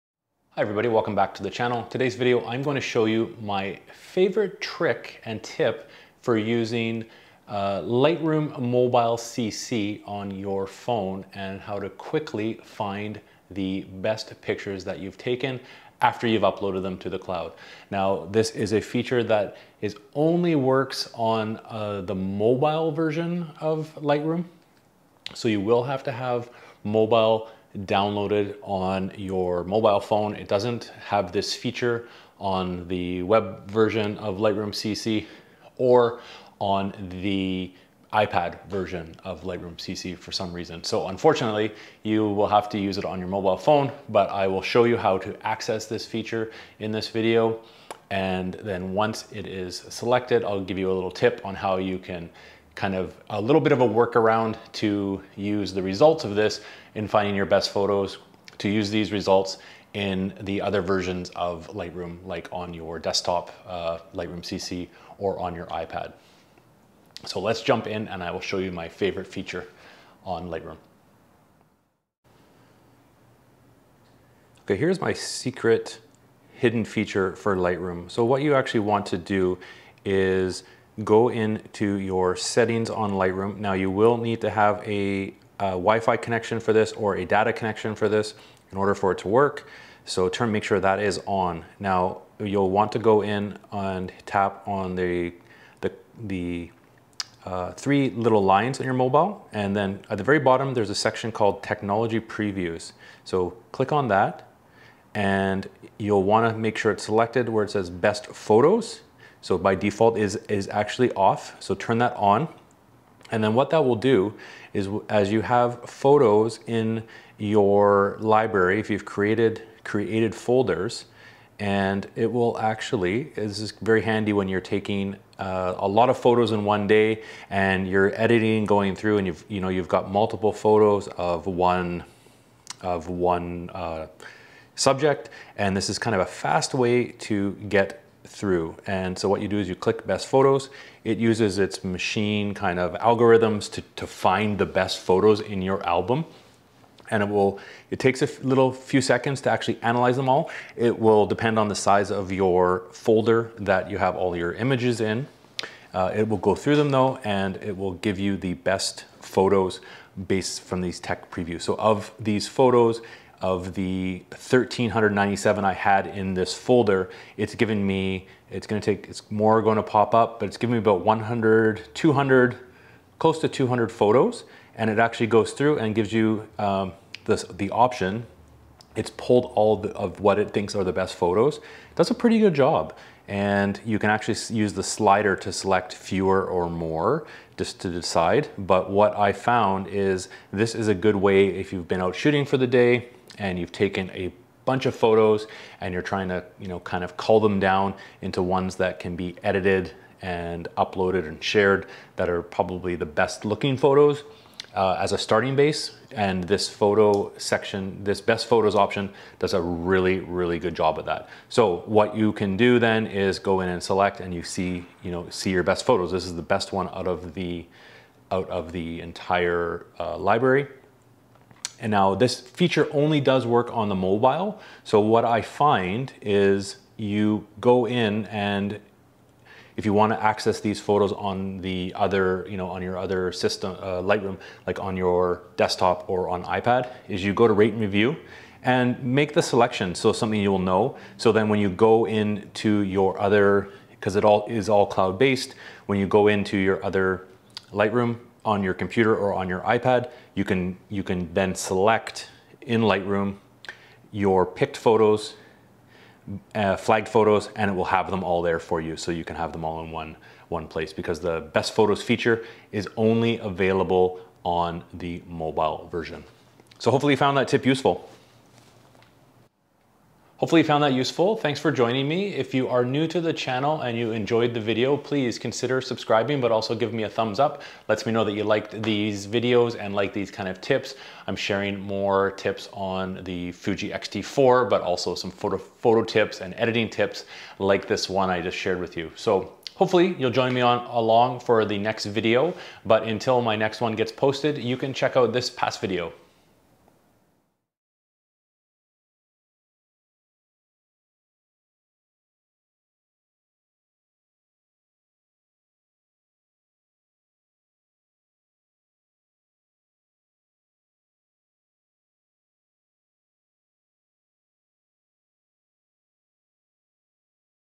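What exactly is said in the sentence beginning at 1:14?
Okay, here's my secret hidden feature for Lightroom.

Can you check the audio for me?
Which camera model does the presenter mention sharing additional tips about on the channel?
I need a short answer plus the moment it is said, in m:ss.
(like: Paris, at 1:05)
Fuji X-T4, at 4:43.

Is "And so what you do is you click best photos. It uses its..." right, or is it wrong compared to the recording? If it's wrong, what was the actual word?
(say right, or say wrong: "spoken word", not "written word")
right.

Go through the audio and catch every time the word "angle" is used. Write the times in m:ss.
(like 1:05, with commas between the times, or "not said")
not said.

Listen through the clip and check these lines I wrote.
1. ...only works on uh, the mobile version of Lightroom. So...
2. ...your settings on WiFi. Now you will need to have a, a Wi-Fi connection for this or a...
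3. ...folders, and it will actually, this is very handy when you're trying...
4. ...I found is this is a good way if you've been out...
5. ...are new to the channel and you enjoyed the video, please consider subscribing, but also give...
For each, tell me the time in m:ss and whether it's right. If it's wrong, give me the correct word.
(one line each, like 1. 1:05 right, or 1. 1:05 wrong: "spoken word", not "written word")
1. 0:20 right
2. 1:21 wrong: "Lightroom", not "WiFi"
3. 2:00 wrong: "taking", not "trying"
4. 3:09 right
5. 4:32 right.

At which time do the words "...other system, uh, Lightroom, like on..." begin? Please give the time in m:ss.
3:52.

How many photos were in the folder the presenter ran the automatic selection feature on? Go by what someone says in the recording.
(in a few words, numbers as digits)
1397.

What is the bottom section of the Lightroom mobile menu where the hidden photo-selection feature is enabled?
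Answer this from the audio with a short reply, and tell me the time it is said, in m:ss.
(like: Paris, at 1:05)
Technology previews, at 1:41.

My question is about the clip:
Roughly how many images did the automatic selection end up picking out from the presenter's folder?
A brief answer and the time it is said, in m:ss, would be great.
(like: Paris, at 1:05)
Close to 200, at 2:53.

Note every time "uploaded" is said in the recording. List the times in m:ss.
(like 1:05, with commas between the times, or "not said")
0:16, 3:20.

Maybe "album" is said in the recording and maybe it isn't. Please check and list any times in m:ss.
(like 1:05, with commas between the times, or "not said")
2:25.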